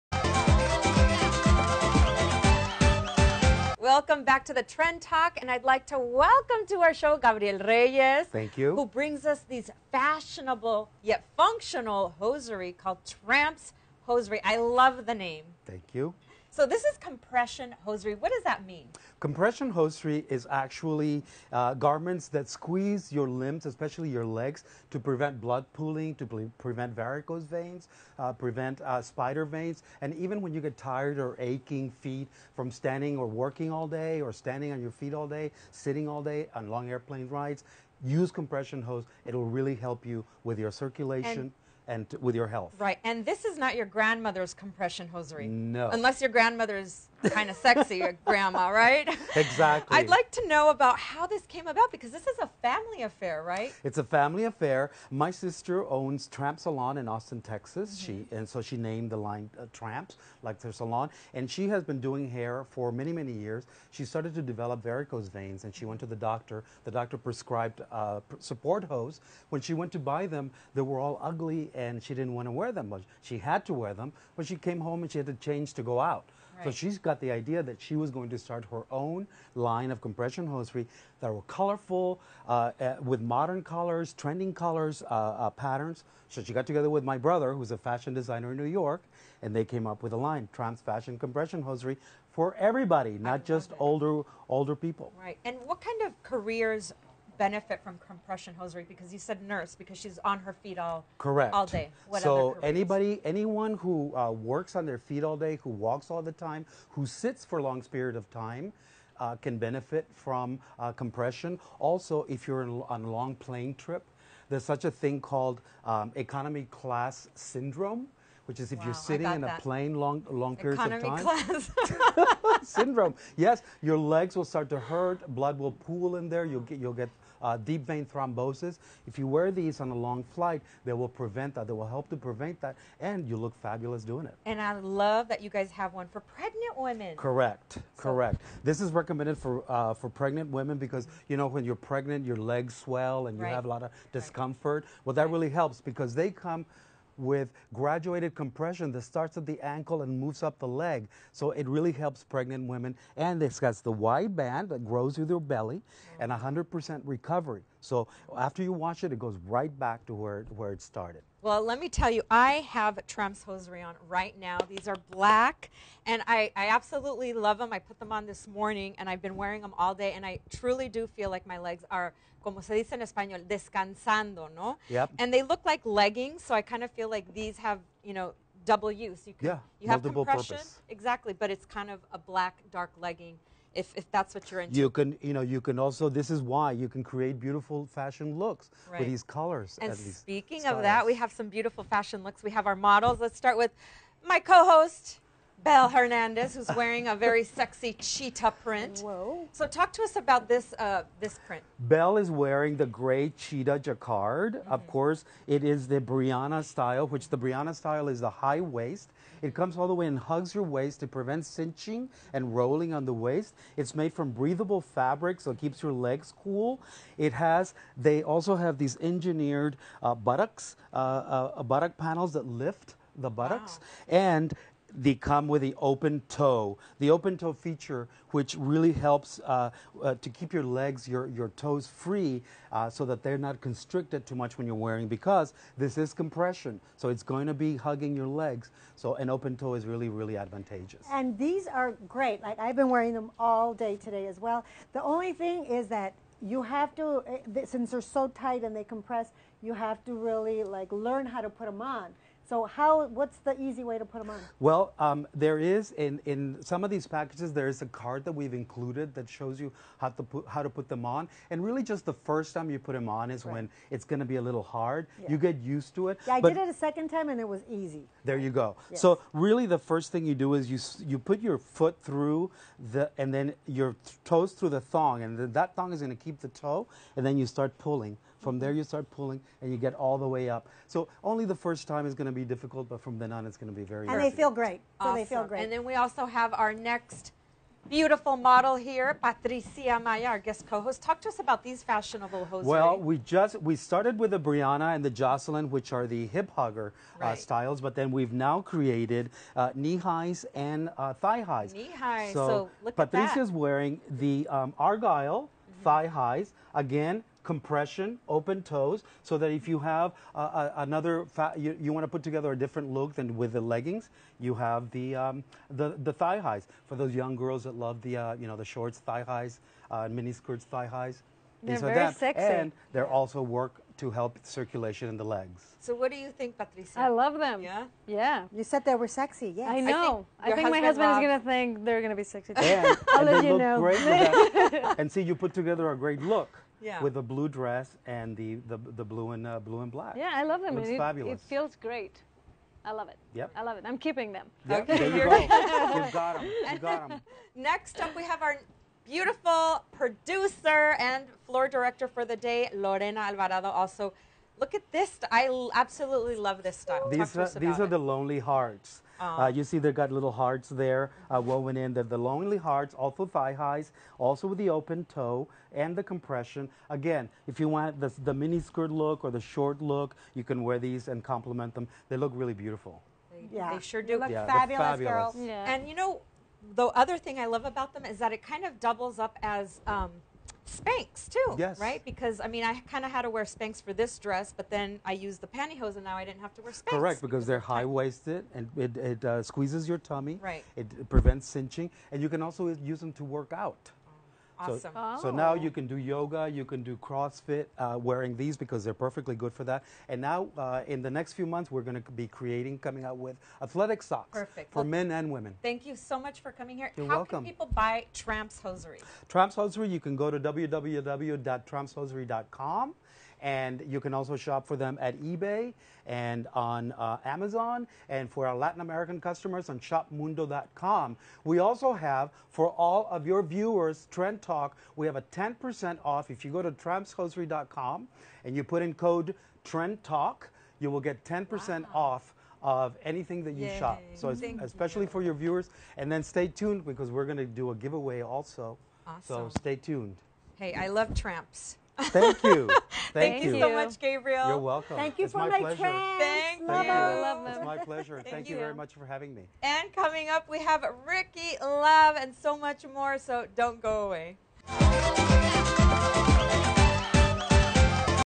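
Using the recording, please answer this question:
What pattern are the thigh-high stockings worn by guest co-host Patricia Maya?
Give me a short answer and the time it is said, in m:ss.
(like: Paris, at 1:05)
Argyle, at 5:04.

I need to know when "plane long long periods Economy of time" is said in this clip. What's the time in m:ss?
1:59.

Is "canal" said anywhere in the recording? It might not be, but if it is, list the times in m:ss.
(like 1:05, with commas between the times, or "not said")
not said.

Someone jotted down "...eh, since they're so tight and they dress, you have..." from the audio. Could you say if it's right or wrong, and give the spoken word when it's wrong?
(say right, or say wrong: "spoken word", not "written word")
wrong: "compress", not "dress".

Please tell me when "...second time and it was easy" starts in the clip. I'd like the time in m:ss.
4:26.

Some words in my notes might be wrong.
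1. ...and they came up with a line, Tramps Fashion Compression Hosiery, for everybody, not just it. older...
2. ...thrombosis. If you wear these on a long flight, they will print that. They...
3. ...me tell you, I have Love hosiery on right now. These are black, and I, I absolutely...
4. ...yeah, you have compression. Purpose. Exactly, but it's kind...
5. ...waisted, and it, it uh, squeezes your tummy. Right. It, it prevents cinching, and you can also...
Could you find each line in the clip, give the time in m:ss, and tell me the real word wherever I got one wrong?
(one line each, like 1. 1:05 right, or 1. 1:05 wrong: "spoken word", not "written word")
1. 1:29 right
2. 2:08 wrong: "prevent", not "print"
3. 2:41 wrong: "Tramps", not "Love"
4. 2:59 right
5. 6:27 right.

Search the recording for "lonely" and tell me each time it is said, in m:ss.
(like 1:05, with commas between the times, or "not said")
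5:57, 6:02.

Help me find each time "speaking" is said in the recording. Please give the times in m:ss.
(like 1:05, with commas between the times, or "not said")
3:09.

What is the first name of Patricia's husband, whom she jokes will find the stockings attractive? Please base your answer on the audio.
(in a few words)
Rob.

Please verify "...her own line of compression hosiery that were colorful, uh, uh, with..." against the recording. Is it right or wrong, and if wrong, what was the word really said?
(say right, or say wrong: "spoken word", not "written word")
right.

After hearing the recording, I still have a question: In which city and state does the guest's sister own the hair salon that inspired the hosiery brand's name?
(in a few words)
Austin, Texas.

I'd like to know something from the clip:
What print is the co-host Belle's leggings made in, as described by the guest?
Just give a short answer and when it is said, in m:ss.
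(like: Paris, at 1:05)
gray cheetah jacquard, at 3:22.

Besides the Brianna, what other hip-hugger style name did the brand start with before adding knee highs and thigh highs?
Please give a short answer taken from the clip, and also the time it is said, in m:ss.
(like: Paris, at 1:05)
Jocelyn, at 4:55.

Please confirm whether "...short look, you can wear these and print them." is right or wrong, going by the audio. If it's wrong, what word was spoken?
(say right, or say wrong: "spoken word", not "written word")
wrong: "complement", not "print".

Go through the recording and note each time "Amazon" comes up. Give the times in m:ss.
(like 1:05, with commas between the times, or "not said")
6:57.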